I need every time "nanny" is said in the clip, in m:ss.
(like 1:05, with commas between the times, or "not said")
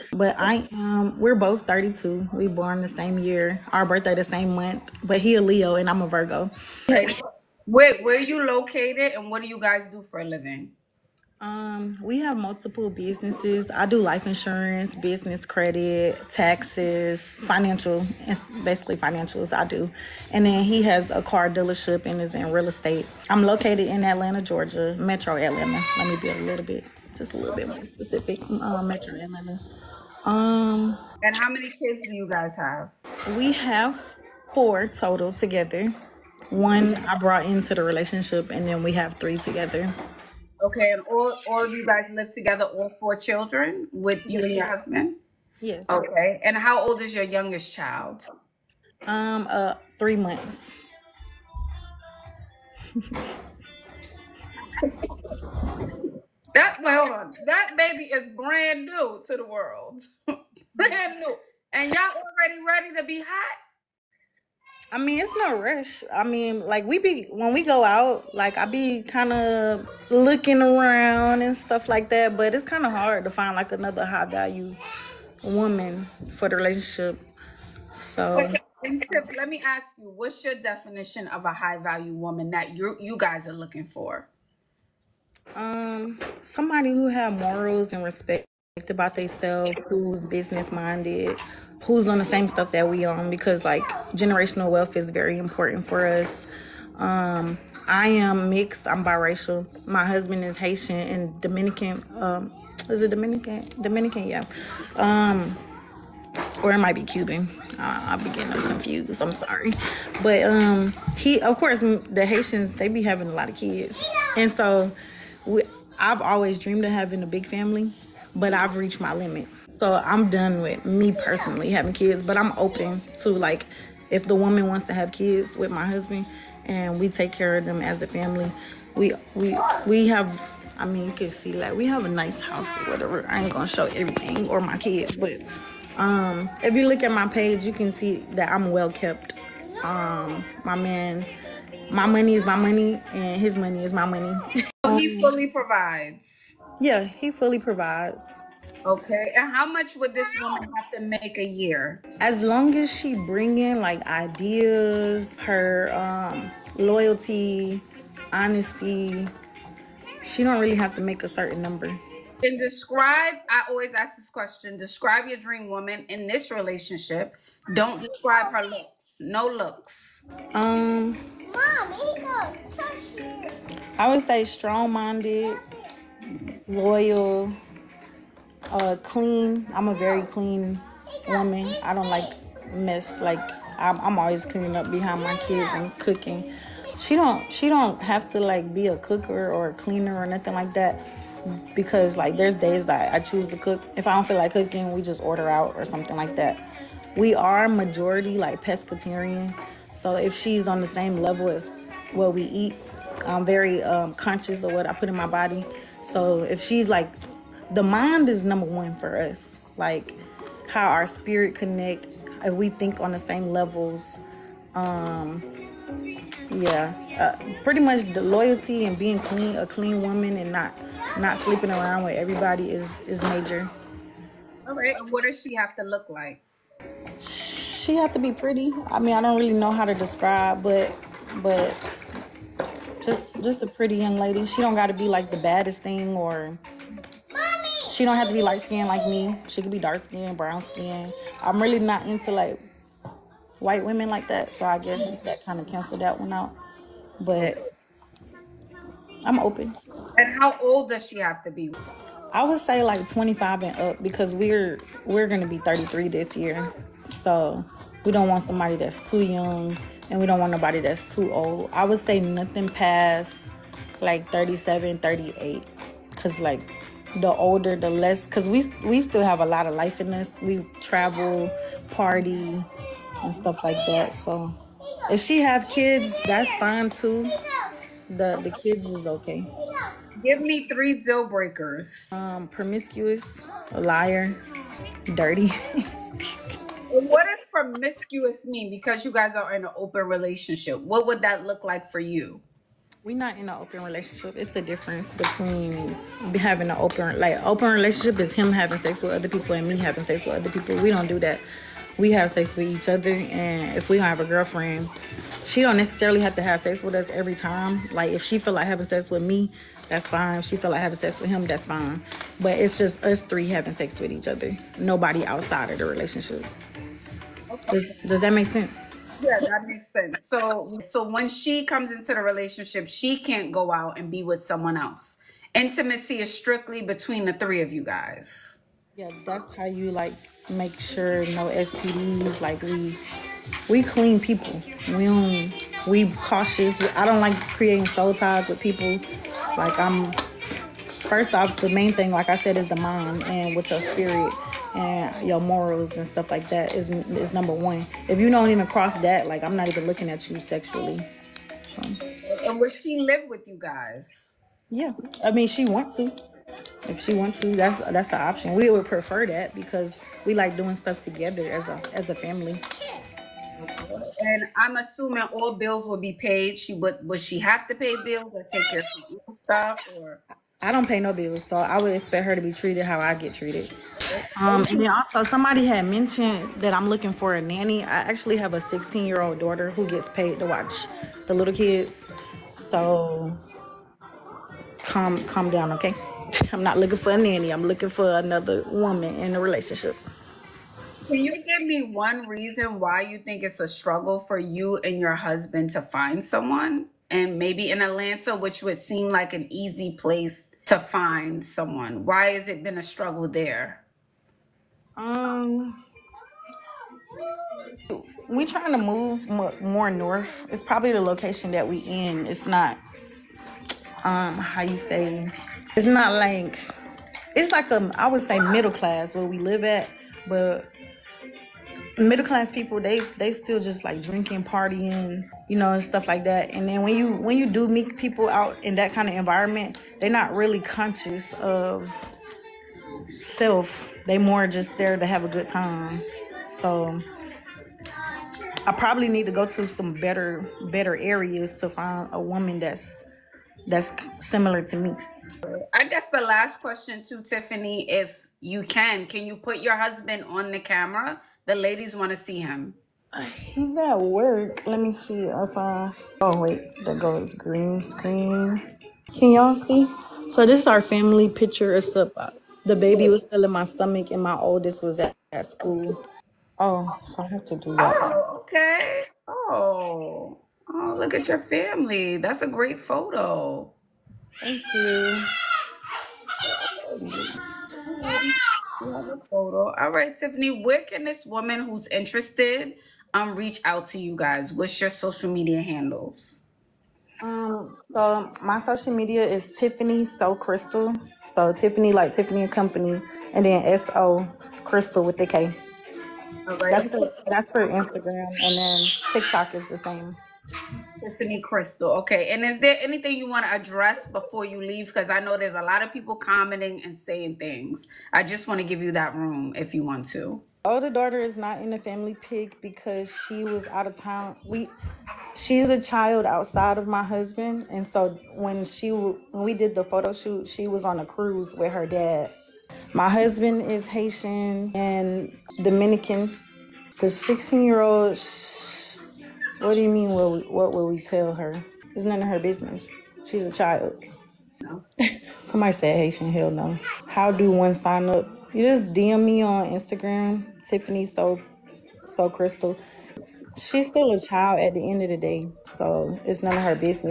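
6:17, 6:27.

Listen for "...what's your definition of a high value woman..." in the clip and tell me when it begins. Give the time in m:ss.
1:20.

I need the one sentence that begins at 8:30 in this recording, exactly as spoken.
Older daughter is not in the family pick because she was out of town.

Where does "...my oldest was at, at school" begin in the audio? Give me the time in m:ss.
7:44.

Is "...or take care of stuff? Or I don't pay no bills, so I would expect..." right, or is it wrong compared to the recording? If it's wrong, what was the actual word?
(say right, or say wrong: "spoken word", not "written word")
right.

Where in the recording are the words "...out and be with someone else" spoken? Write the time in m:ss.
5:23.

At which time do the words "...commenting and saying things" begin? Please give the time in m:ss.
8:26.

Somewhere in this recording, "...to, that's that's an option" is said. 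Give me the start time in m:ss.
5:57.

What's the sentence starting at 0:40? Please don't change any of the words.
Okay, and all, all of you guys live together, all four children with you and your husband?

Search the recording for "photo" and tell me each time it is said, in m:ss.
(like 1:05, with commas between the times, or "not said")
7:52, 7:59, 8:39.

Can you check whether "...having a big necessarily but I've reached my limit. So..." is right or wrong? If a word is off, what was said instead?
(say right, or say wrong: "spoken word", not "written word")
wrong: "family", not "necessarily".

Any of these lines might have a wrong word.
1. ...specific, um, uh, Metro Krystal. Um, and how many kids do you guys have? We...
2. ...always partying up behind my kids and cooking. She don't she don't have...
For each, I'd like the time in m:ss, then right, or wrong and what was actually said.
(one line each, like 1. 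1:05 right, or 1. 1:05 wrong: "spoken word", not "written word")
1. 0:27 wrong: "Atlanta", not "Krystal"
2. 3:04 wrong: "cleaning", not "partying".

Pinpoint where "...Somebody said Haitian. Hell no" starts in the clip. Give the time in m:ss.
8:55.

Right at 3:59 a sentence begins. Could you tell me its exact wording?
She could be dark skinned, brown skinned.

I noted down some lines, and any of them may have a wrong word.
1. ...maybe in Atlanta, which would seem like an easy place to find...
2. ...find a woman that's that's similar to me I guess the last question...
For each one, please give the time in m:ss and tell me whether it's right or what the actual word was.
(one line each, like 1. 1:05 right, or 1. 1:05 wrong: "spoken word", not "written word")
1. 6:37 right
2. 7:21 right.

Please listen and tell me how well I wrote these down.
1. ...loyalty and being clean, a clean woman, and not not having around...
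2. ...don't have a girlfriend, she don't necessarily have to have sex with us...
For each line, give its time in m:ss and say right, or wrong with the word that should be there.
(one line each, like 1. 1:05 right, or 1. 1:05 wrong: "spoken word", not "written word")
1. 3:38 wrong: "sleeping", not "having"
2. 5:03 right.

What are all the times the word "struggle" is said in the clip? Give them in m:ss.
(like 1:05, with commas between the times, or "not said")
6:33, 6:42.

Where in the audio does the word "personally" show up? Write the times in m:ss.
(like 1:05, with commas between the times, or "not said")
2:01.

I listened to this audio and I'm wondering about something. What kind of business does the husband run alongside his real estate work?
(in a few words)
Car dealership.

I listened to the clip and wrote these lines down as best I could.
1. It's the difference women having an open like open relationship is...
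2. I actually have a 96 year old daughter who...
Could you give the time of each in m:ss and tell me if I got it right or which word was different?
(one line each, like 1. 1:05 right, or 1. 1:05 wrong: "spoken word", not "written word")
1. 4:54 wrong: "between", not "women"
2. 6:17 wrong: "16", not "96".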